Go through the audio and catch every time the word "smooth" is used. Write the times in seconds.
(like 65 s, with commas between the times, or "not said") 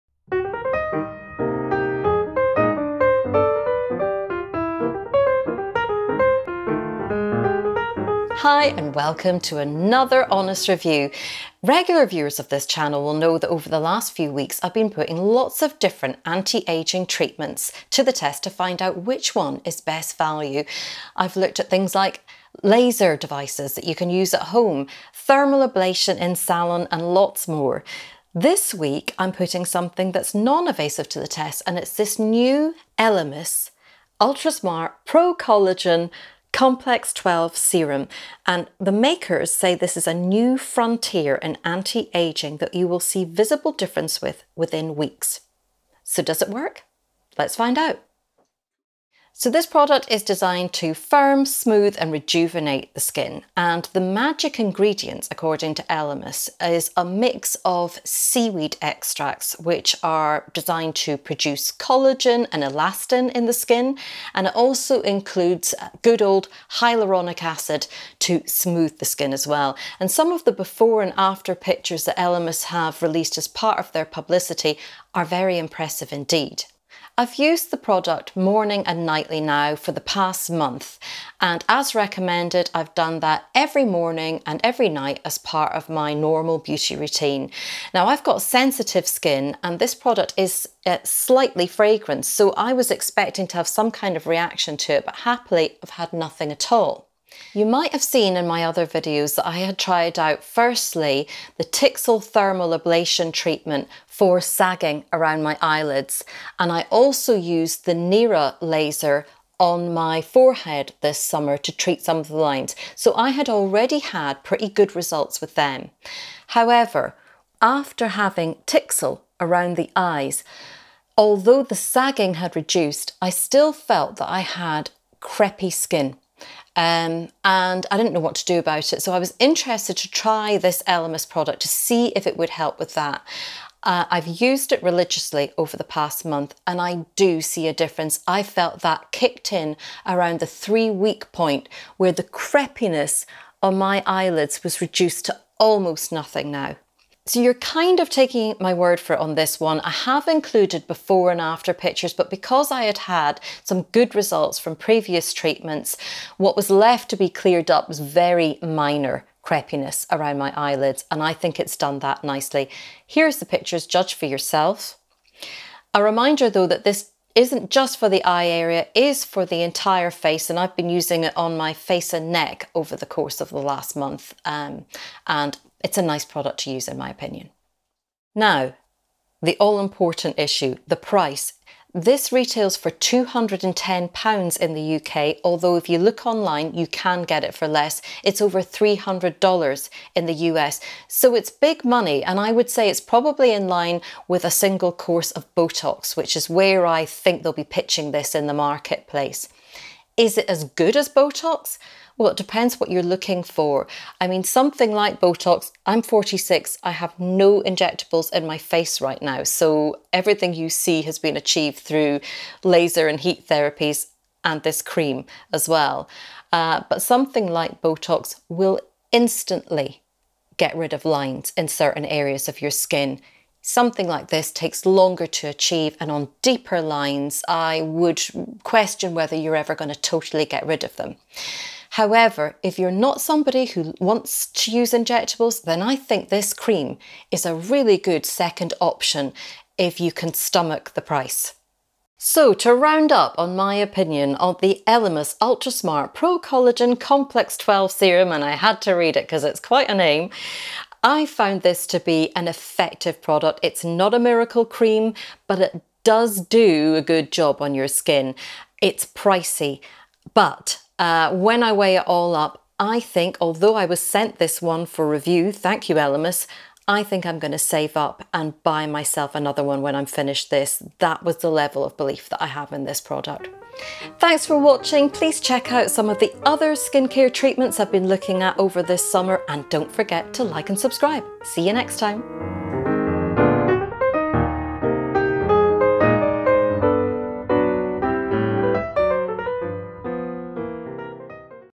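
51 s, 68 s.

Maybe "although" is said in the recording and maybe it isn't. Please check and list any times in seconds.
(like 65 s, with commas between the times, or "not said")
121 s, 185 s, 263 s.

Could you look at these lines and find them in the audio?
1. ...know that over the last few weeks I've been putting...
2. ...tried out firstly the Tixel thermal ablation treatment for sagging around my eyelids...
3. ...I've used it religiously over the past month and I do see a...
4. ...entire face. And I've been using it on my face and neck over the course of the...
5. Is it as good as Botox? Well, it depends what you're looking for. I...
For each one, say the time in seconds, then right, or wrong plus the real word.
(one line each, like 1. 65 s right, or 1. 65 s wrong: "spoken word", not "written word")
1. 13 s right
2. 99 s right
3. 134 s right
4. 169 s right
5. 200 s right.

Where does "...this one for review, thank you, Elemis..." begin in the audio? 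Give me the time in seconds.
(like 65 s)
264 s.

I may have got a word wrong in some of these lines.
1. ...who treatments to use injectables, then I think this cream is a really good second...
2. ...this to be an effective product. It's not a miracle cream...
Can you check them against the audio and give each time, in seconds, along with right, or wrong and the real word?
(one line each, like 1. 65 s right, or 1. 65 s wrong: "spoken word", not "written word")
1. 233 s wrong: "wants", not "treatments"
2. 251 s right.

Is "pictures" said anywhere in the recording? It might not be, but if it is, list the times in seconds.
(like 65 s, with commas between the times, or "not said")
71 s, 151 s, 163 s.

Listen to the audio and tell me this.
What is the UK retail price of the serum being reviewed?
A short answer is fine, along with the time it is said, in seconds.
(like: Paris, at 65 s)
£210, at 182 s.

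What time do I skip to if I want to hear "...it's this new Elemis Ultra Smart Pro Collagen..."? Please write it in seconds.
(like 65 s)
31 s.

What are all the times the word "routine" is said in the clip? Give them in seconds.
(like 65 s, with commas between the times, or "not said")
86 s.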